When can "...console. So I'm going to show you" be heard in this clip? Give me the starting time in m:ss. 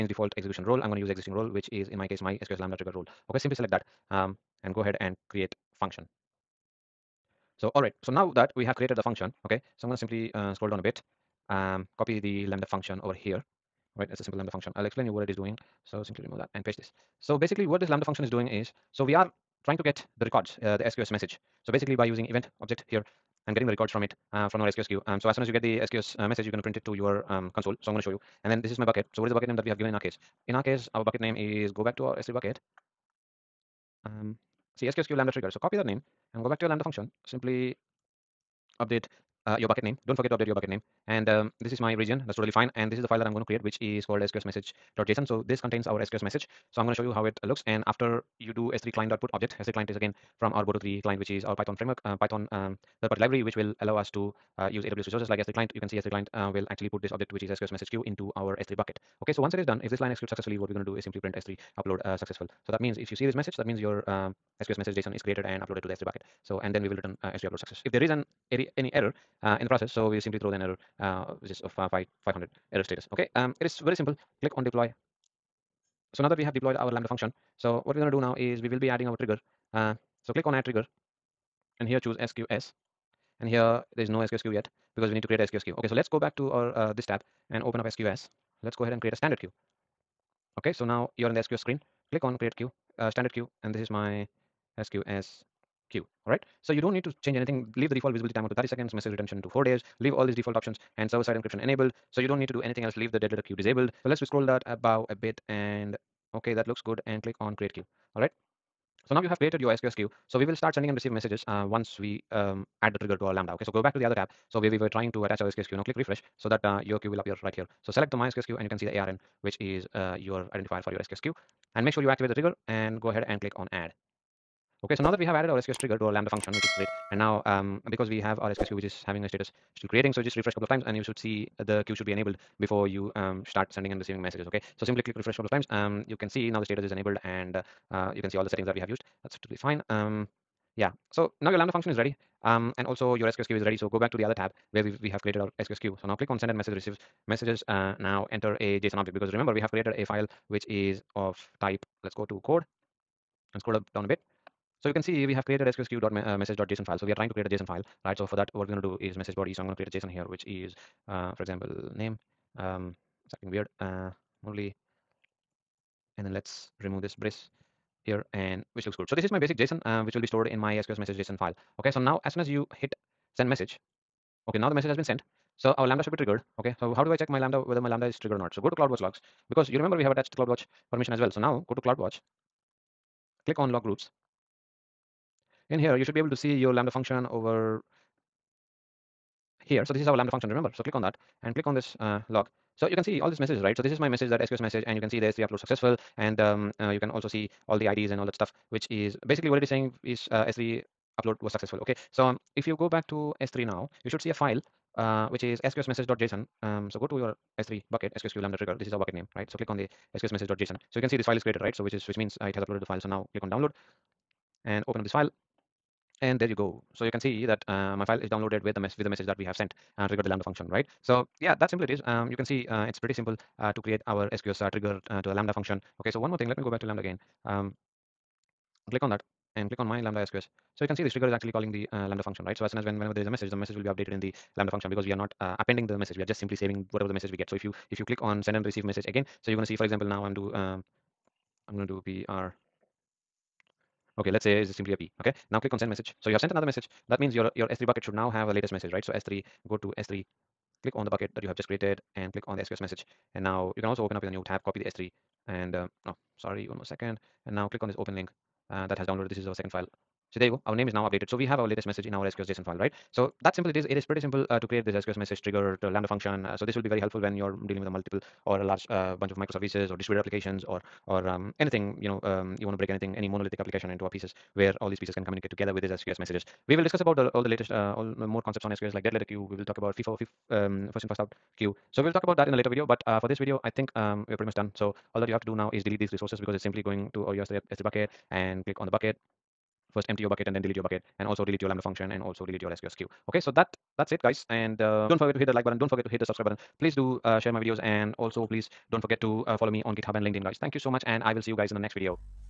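0:27.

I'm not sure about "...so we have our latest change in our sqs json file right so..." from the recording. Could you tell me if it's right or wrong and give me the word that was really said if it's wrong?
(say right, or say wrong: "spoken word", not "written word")
wrong: "message", not "change".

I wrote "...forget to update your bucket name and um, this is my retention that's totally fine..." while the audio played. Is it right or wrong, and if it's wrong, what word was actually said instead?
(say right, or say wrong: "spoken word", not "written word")
wrong: "region", not "retention".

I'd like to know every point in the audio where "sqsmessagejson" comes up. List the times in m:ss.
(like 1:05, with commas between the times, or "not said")
3:25, 3:30.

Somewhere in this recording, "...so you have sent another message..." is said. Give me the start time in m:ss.
4:06.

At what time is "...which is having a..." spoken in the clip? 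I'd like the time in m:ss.
2:08.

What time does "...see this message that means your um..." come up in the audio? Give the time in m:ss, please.
1:03.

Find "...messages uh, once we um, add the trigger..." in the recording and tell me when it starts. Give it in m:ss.
1:51.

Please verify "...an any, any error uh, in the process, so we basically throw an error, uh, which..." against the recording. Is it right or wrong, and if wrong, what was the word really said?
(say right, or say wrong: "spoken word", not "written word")
wrong: "simply", not "basically".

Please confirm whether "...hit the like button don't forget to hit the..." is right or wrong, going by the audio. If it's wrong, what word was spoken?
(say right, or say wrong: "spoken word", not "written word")
right.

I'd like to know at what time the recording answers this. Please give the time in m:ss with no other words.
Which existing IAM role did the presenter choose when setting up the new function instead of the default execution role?
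0:02.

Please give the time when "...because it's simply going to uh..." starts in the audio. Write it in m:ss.
4:46.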